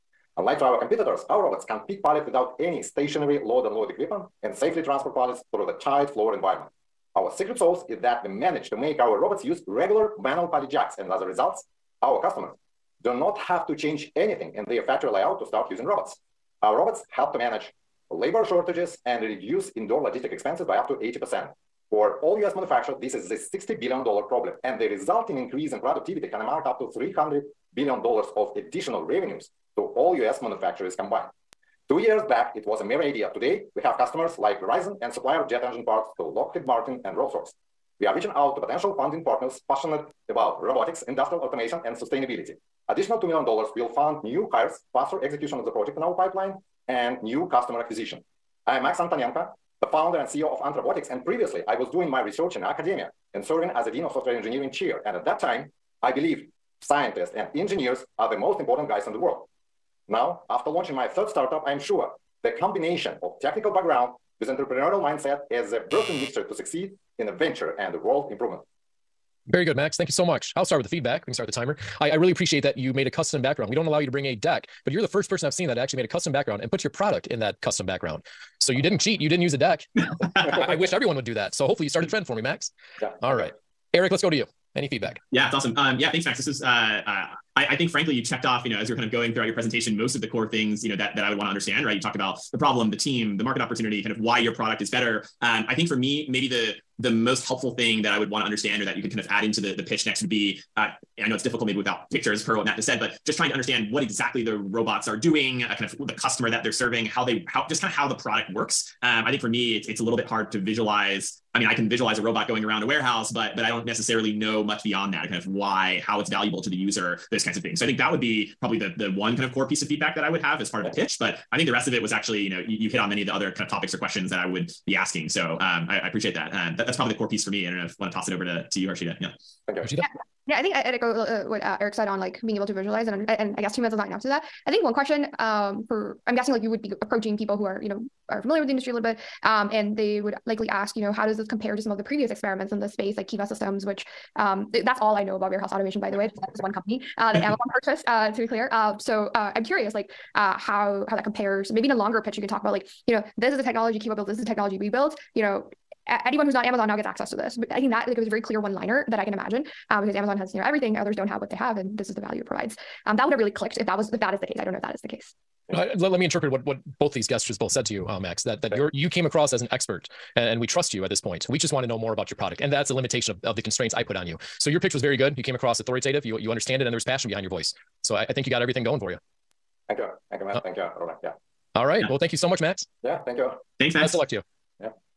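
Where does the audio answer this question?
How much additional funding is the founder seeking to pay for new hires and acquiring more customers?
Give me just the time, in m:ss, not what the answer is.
0:43.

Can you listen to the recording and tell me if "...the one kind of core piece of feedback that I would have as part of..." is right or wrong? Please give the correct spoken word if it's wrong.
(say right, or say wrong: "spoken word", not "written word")
right.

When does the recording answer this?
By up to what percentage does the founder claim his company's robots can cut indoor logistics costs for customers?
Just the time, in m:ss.
0:20.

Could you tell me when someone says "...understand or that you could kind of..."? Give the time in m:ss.
1:38.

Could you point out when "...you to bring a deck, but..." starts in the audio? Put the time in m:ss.
1:13.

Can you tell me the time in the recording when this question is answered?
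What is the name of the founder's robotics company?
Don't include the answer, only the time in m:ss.
0:50.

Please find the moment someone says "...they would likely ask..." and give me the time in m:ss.
2:19.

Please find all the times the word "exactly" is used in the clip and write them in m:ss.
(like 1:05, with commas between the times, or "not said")
1:44.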